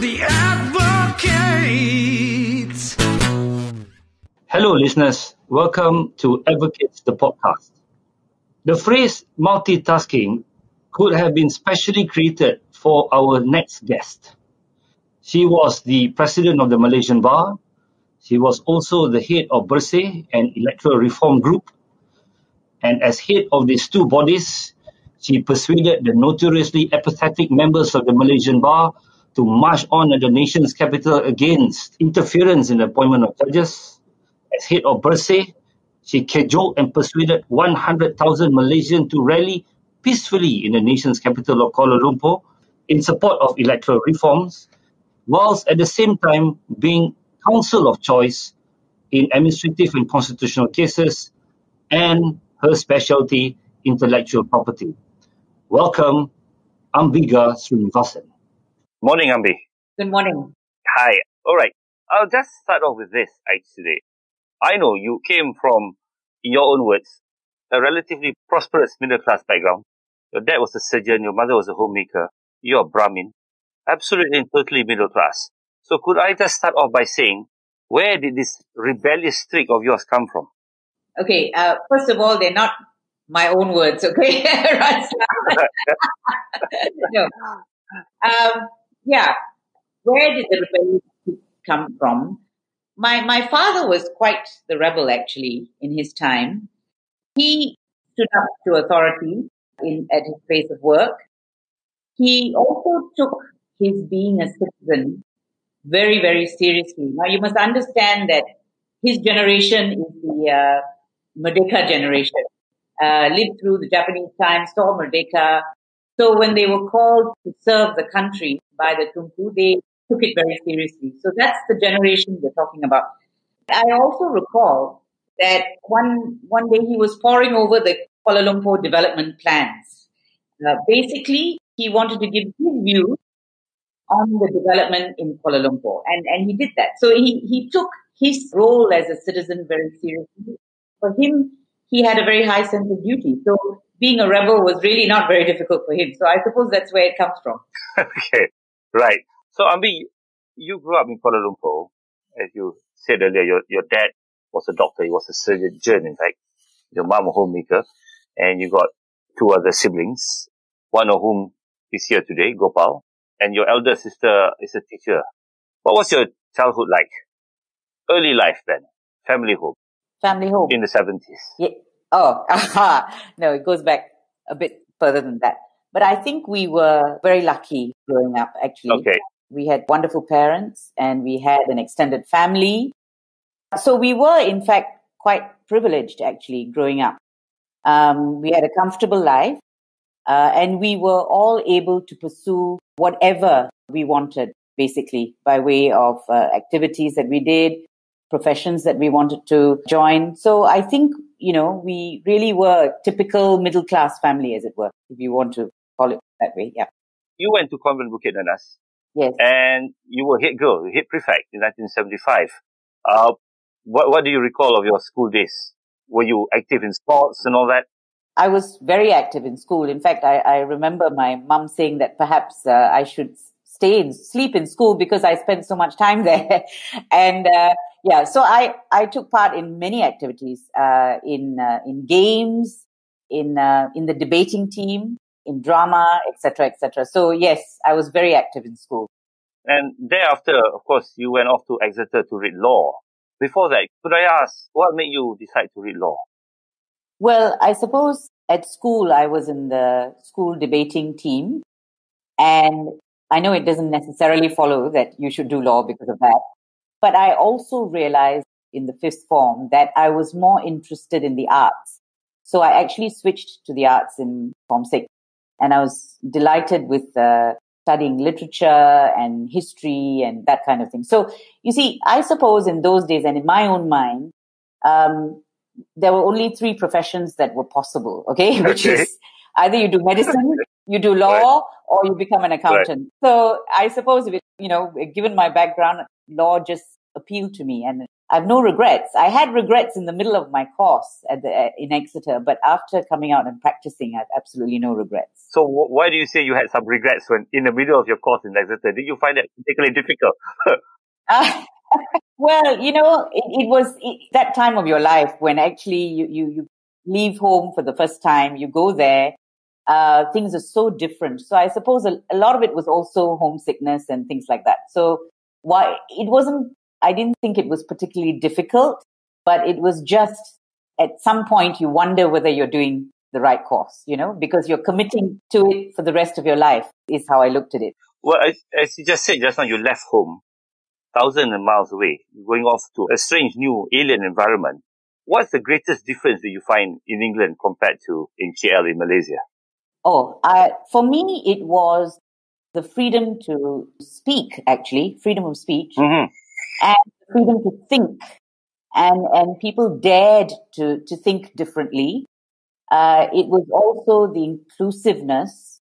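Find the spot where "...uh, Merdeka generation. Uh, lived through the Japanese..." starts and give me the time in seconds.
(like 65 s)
110 s.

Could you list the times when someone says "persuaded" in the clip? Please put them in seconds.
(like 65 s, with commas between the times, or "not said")
25 s, 36 s.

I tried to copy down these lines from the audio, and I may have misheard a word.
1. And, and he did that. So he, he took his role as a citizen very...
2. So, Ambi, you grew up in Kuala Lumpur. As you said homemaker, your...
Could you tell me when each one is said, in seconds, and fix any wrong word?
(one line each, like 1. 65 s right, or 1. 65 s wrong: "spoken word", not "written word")
1. 136 s right
2. 149 s wrong: "earlier", not "homemaker".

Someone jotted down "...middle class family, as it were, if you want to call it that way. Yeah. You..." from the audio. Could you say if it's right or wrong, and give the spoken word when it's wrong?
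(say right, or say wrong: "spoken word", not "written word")
right.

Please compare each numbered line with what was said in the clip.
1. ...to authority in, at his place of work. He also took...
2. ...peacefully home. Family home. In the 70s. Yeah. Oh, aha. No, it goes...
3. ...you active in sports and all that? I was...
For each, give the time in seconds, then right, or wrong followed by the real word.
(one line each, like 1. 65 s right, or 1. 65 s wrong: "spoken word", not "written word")
1. 98 s right
2. 169 s wrong: "family", not "peacefully"
3. 216 s right.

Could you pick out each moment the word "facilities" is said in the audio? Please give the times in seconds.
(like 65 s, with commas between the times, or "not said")
not said.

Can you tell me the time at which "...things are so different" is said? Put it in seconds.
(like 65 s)
310 s.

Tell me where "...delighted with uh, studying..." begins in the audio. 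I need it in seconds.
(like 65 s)
266 s.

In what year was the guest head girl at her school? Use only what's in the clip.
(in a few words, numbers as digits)
1975.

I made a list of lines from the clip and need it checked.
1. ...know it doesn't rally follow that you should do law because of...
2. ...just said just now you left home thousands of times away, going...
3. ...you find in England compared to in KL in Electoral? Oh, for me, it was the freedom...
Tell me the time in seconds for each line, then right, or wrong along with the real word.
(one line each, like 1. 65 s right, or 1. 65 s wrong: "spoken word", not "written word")
1. 253 s wrong: "necessarily", not "rally"
2. 329 s wrong: "miles", not "times"
3. 336 s wrong: "Malaysia", not "Electoral".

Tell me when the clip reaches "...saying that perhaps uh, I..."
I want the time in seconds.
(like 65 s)
221 s.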